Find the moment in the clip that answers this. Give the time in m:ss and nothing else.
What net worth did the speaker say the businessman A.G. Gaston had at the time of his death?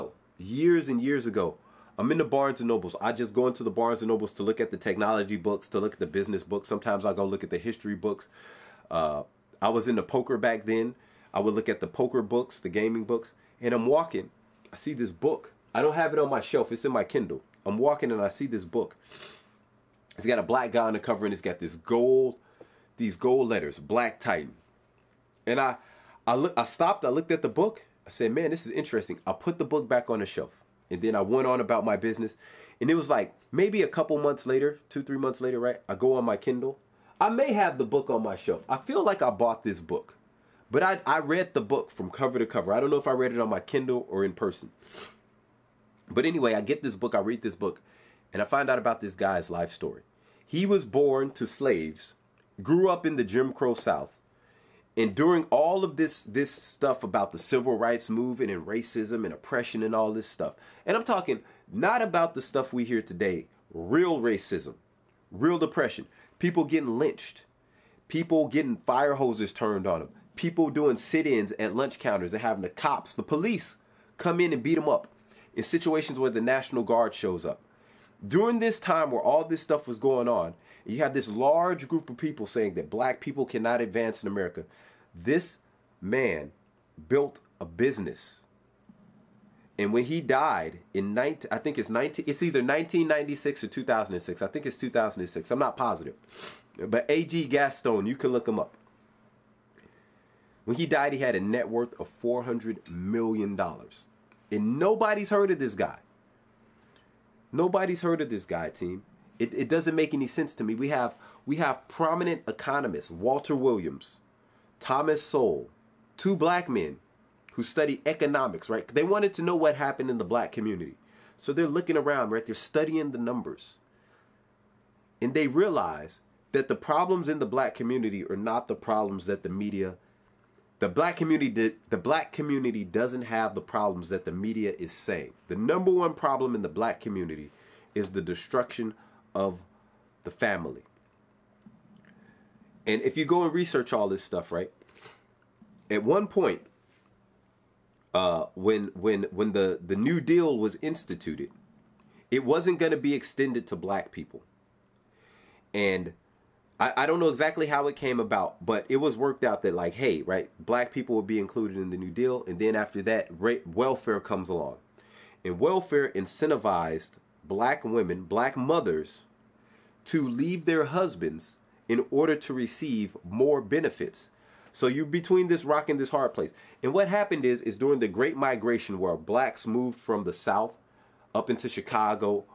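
1:42.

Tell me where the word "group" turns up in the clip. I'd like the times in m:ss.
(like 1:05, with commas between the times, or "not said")
1:21.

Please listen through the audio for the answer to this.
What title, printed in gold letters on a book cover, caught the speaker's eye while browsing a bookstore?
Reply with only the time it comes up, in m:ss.
0:23.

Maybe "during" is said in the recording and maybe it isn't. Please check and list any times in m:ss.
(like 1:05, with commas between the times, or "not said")
0:55, 1:18, 2:57.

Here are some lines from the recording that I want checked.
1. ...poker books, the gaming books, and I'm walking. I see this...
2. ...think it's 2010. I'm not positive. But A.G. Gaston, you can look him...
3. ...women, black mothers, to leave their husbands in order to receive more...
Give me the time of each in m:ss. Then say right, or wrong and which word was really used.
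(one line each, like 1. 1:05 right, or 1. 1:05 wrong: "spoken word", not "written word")
1. 0:11 right
2. 1:34 wrong: "2006", not "2010"
3. 2:47 right.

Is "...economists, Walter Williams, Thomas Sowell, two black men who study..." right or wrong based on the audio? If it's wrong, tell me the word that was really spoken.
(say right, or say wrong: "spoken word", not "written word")
right.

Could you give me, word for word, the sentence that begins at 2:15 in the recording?
The number one problem in the black community is the destruction of the family.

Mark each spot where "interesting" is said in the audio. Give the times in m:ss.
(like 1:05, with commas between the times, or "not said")
0:28.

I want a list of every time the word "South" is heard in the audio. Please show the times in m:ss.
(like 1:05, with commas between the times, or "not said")
0:53, 3:00.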